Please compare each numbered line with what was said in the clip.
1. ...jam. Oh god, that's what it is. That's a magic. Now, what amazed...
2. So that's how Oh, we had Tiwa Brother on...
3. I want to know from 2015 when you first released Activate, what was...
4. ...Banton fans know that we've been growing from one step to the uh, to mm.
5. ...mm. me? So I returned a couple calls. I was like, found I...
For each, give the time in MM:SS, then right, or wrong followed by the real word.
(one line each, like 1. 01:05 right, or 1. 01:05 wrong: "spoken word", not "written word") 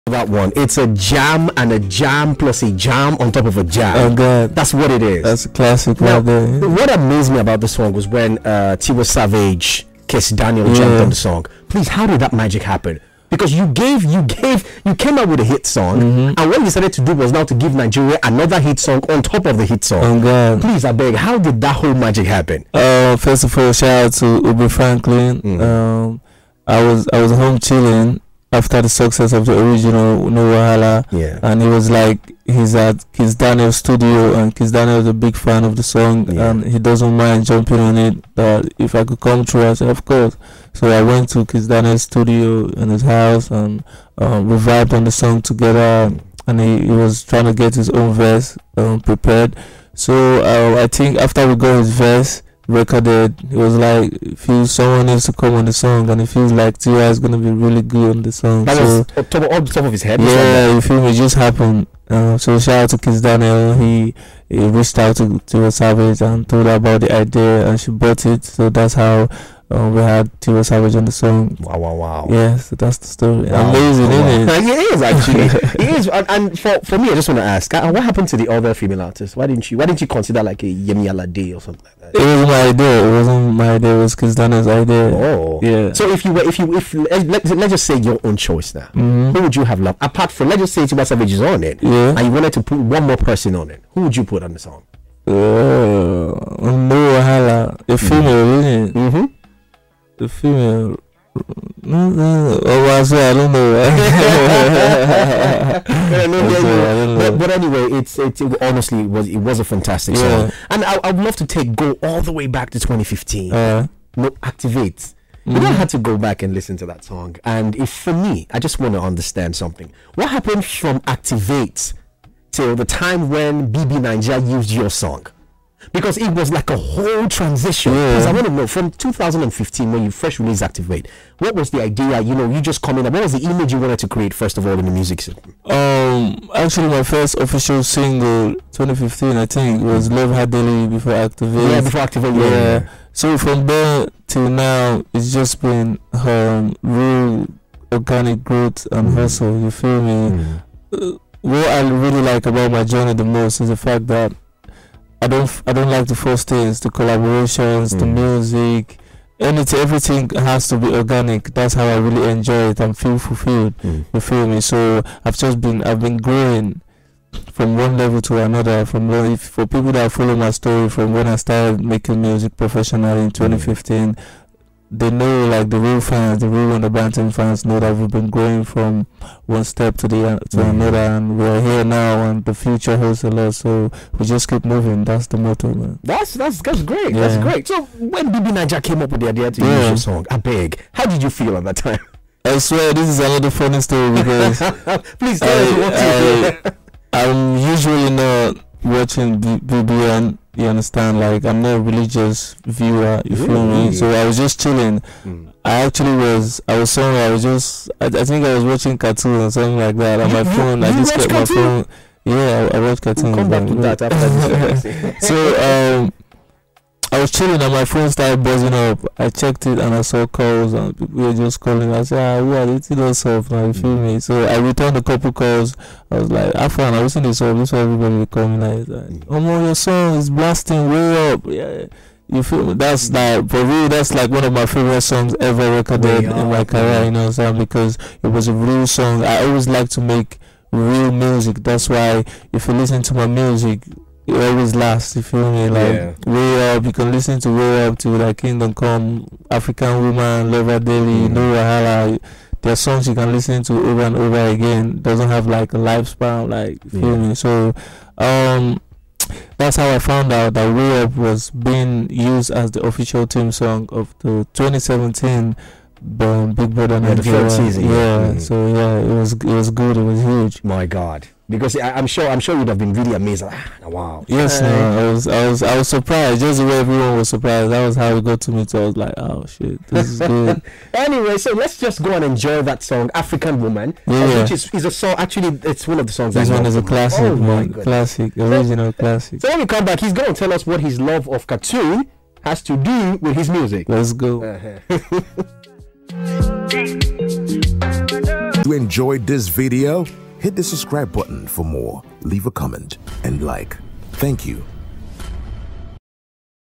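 1. 00:03 wrong: "classic", not "magic"
2. 01:08 wrong: "Savage", not "Brother"
3. 02:08 right
4. 02:56 right
5. 03:43 right.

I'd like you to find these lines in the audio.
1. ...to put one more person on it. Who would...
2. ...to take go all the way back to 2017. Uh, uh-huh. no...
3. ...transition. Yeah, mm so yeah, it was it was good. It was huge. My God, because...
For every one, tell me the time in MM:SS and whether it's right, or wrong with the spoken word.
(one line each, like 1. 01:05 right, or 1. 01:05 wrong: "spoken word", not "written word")
1. 01:32 right
2. 01:51 wrong: "2015", not "2017"
3. 04:27 wrong: "season", not "transition".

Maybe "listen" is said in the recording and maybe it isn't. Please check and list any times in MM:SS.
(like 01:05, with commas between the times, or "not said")
01:56, 04:02, 04:07, 04:13.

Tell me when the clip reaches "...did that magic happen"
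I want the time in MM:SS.
00:12.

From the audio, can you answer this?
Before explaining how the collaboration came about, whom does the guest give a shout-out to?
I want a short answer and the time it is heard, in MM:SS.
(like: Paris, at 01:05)
Uber Franklin, at 00:24.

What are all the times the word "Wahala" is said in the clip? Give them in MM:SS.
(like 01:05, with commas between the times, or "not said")
00:30, 04:11.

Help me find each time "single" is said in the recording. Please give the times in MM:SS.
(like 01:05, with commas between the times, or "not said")
02:17.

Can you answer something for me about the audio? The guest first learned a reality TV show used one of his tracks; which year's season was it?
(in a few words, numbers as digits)
2017.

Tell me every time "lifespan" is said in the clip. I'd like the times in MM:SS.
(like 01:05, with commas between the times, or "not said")
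04:15.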